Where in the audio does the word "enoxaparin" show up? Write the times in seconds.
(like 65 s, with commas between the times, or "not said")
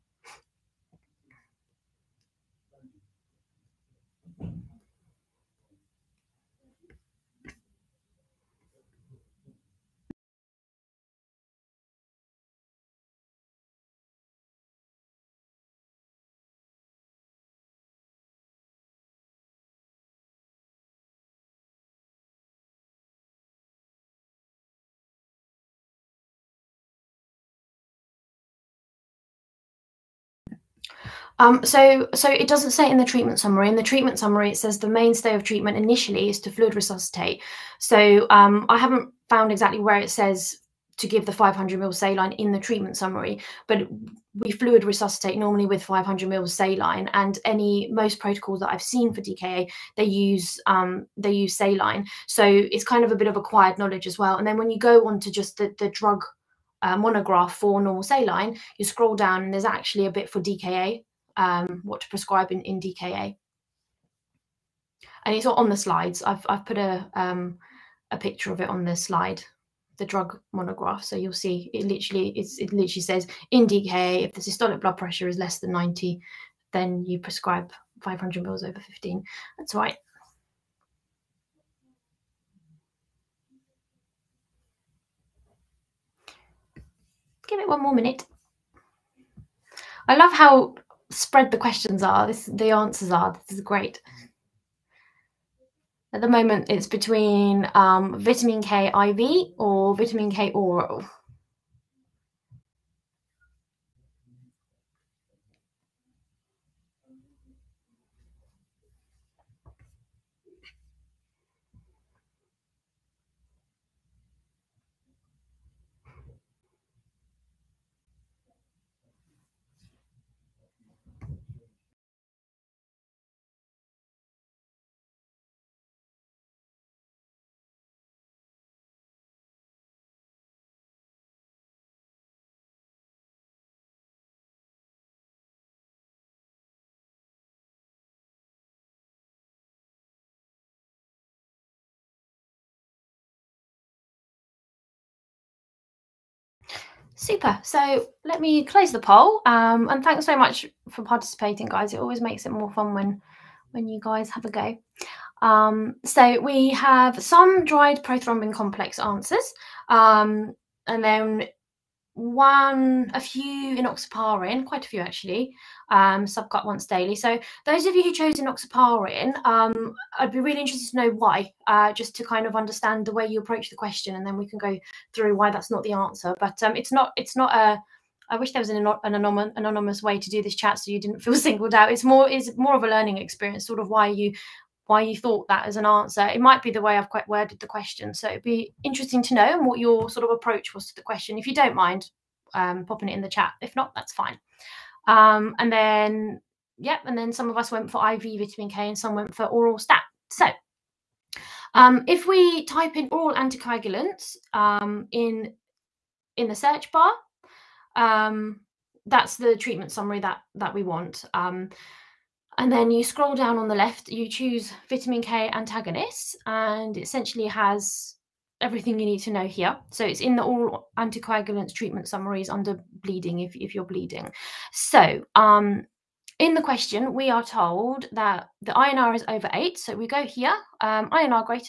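163 s, 168 s.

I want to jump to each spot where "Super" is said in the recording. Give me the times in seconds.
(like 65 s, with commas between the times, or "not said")
147 s.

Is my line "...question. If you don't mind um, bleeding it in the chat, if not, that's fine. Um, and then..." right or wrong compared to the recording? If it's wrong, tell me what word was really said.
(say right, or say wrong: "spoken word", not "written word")
wrong: "popping", not "bleeding".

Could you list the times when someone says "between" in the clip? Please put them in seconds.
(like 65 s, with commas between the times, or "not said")
96 s.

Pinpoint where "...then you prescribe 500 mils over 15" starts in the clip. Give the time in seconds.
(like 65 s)
76 s.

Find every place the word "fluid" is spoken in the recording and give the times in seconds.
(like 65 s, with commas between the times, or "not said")
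36 s, 44 s.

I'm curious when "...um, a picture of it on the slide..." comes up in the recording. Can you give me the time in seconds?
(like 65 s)
67 s.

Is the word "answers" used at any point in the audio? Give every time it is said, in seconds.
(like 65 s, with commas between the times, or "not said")
92 s, 158 s, 175 s, 185 s.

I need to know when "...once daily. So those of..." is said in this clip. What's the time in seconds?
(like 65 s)
166 s.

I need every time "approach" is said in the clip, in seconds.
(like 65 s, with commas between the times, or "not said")
173 s, 190 s.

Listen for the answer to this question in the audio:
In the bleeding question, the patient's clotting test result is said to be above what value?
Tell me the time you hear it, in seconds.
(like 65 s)
229 s.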